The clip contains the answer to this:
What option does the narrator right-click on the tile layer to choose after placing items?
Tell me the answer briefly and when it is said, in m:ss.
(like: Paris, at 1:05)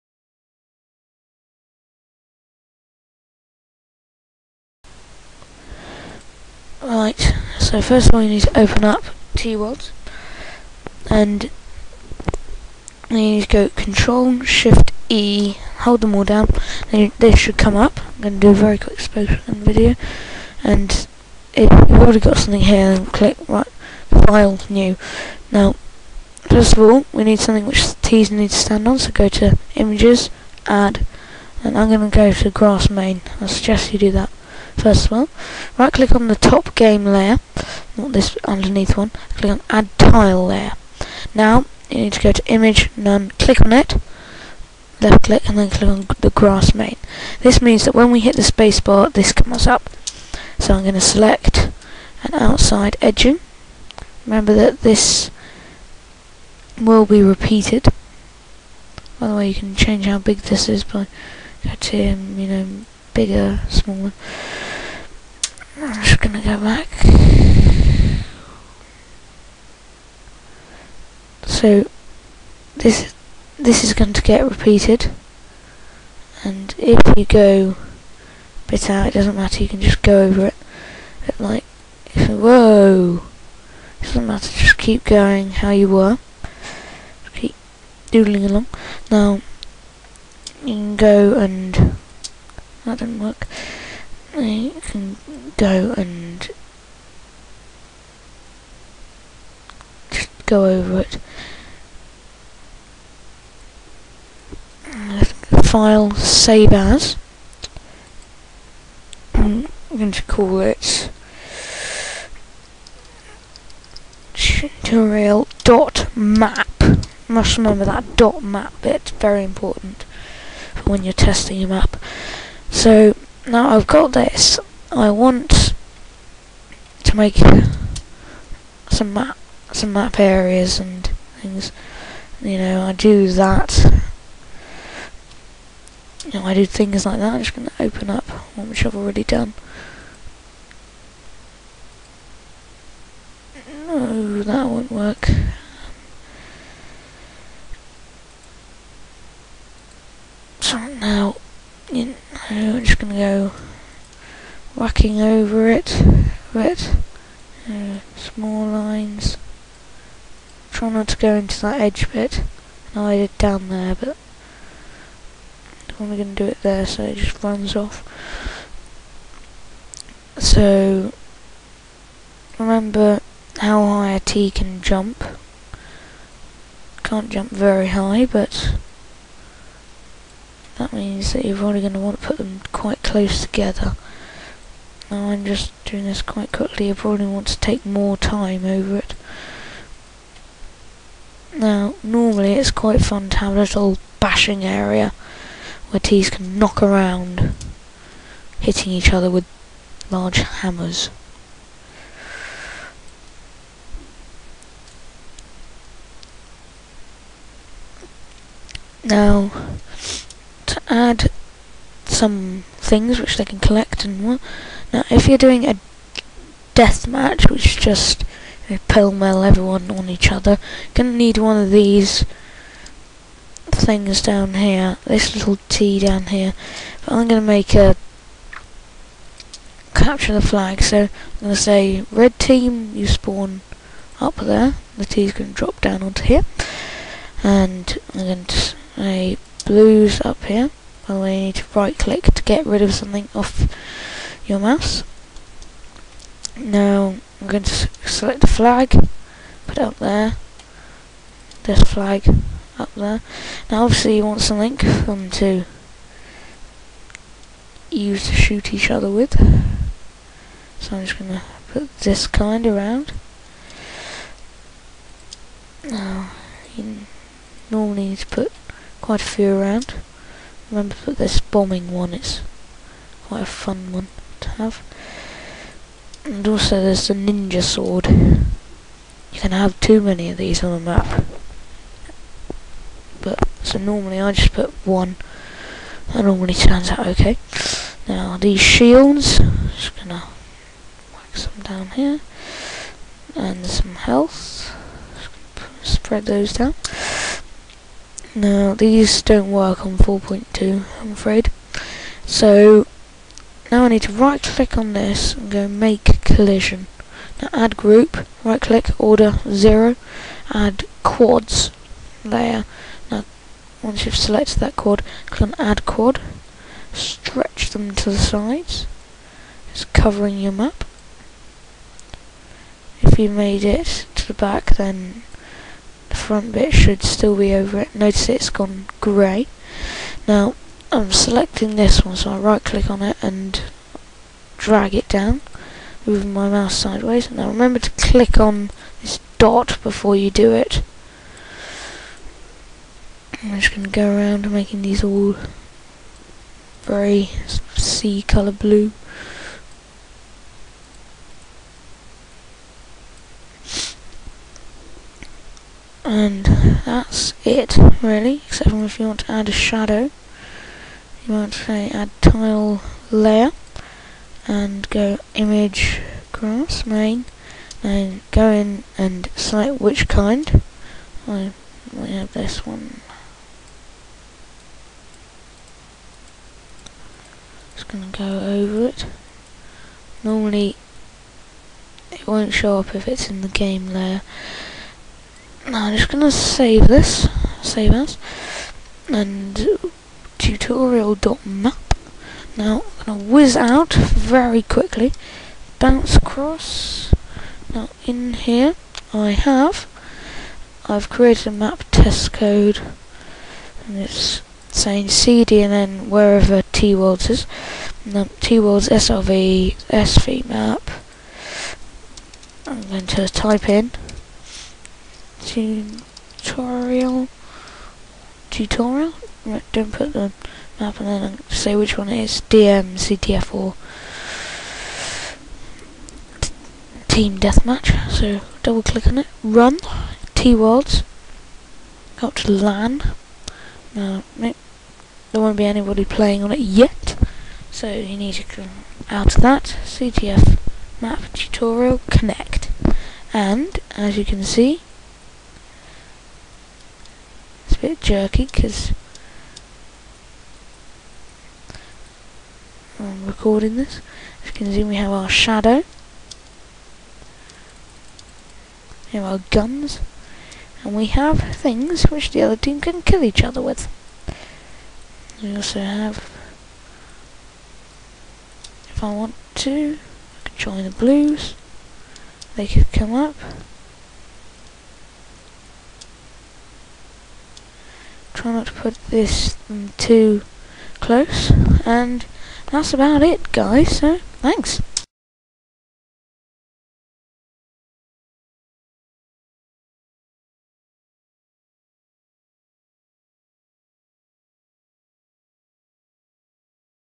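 make collision, at 5:05.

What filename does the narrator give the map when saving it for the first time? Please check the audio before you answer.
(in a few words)
tutorial.map.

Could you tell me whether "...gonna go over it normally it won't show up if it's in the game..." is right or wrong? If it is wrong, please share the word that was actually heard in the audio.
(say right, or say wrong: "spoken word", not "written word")
right.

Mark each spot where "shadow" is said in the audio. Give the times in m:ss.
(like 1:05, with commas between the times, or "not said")
5:59, 7:35.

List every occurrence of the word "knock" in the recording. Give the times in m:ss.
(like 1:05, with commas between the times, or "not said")
3:16.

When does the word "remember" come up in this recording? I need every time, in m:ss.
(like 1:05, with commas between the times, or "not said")
0:54, 1:57, 2:52, 4:30, 5:37.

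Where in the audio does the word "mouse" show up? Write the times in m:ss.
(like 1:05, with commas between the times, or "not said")
4:04, 5:36.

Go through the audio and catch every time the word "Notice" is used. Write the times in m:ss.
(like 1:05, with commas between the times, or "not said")
5:27.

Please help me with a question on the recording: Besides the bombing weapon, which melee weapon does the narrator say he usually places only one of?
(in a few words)
ninja sword.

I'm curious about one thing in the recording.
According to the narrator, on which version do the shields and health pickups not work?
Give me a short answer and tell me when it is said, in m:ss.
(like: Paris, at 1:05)
4.2, at 4:59.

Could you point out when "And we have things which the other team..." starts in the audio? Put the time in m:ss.
7:40.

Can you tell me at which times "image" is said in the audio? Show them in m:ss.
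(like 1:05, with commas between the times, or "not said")
0:29, 0:42, 6:05.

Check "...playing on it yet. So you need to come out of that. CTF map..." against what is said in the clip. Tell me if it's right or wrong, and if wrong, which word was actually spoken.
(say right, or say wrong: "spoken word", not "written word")
right.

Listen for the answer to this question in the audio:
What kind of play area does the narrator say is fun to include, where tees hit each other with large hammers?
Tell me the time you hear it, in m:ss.
3:13.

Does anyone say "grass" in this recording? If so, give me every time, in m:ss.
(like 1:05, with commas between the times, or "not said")
0:32, 0:46, 6:06.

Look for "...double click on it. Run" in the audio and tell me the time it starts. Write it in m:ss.
7:08.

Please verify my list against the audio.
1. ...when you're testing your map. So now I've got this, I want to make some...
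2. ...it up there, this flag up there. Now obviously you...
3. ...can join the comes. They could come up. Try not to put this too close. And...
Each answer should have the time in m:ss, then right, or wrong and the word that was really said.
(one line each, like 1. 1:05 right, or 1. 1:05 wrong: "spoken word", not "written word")
1. 2:00 right
2. 4:09 right
3. 7:50 wrong: "blues", not "comes".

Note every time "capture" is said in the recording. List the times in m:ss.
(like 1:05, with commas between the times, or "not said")
3:49.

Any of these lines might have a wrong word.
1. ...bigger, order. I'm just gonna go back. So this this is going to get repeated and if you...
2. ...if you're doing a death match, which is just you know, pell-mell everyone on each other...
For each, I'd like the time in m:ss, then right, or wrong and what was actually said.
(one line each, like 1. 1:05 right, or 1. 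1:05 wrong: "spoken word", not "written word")
1. 1:03 wrong: "smaller", not "order"
2. 3:35 right.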